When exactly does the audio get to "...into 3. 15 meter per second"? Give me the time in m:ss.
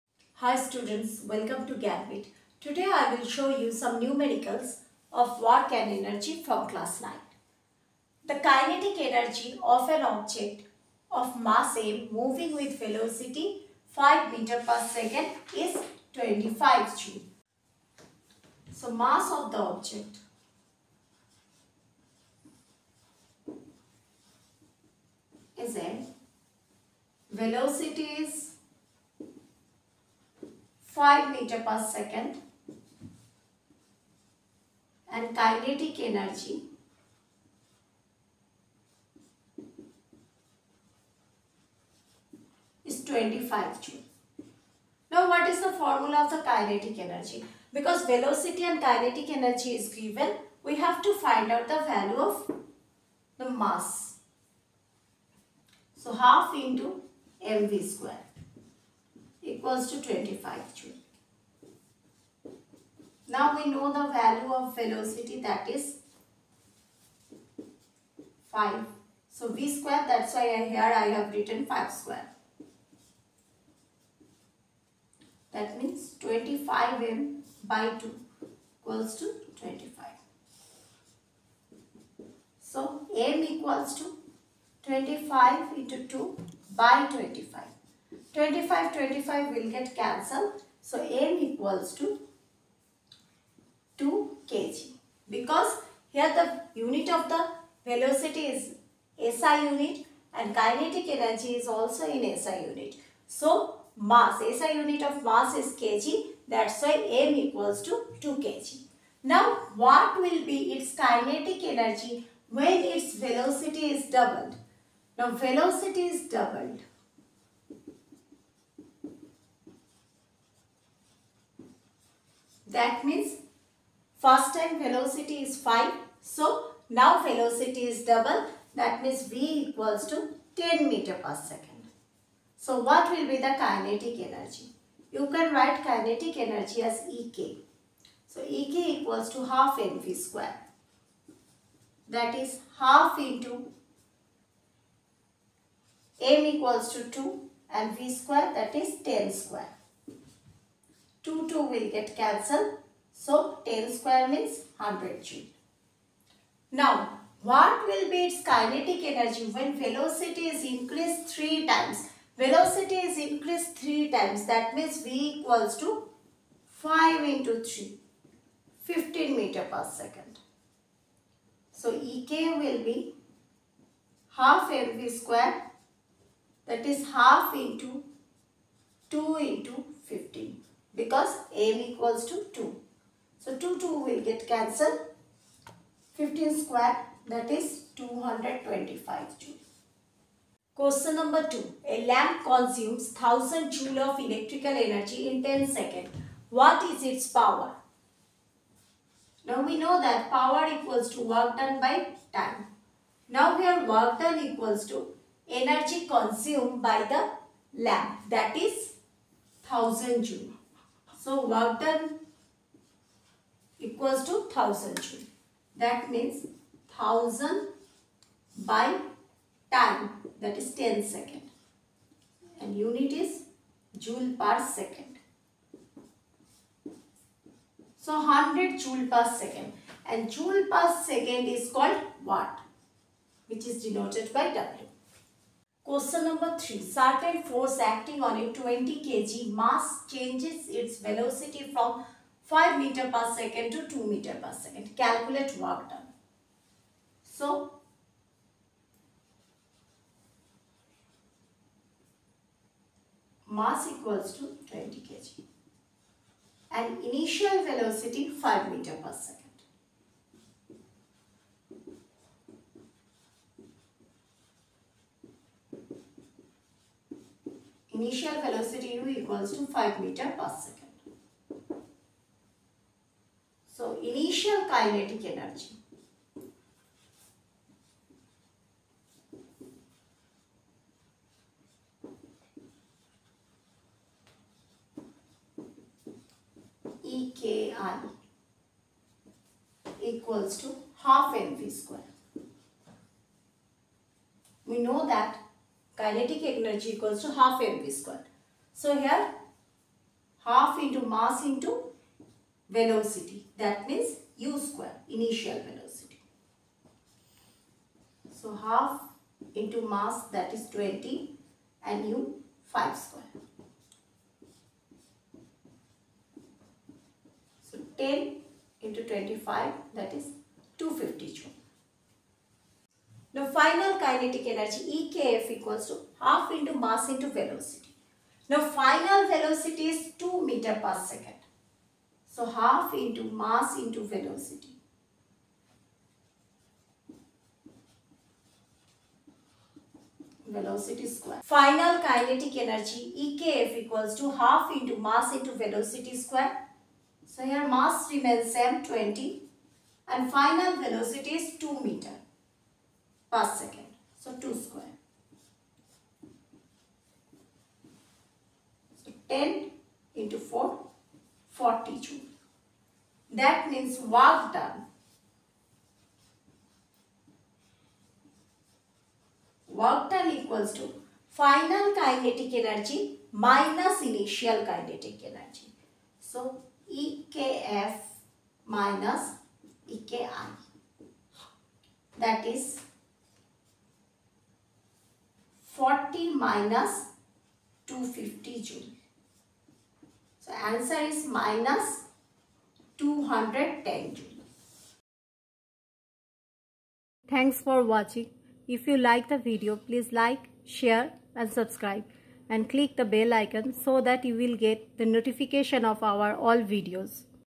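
2:47.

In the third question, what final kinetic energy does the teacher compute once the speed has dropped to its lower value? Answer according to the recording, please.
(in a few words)
40 joule.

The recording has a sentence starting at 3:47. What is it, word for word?
So 100 joule per second and joule per second is called watt which is denoted by W.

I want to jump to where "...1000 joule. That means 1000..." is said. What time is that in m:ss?
3:34.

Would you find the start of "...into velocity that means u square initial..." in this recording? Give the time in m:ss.
5:01.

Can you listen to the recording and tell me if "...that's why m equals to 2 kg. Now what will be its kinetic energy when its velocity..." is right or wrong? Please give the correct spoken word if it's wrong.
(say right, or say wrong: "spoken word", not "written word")
right.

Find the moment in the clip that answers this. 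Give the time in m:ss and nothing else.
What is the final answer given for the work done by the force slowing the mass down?
6:31.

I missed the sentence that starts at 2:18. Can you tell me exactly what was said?
So Ek equals to half mv square.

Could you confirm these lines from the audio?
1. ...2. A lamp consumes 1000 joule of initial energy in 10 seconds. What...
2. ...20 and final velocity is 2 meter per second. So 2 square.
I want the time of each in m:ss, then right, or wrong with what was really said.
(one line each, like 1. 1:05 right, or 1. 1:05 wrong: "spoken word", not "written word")
1. 3:11 wrong: "electrical", not "initial"
2. 5:48 right.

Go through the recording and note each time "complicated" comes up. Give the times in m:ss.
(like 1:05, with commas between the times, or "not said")
not said.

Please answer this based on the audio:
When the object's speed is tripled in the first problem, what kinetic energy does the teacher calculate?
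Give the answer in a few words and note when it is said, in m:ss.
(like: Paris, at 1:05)
225 joule, at 3:07.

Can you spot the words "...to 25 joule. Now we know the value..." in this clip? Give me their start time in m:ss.
0:59.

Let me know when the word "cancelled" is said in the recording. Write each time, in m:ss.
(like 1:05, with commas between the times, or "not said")
1:29, 2:32, 3:04.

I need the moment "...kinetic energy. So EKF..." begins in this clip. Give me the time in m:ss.
6:14.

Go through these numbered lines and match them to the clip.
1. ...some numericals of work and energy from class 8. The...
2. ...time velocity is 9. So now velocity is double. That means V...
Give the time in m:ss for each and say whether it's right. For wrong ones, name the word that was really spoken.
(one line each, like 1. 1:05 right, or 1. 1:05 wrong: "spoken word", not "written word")
1. 0:03 wrong: "9", not "8"
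2. 2:04 wrong: "5", not "9".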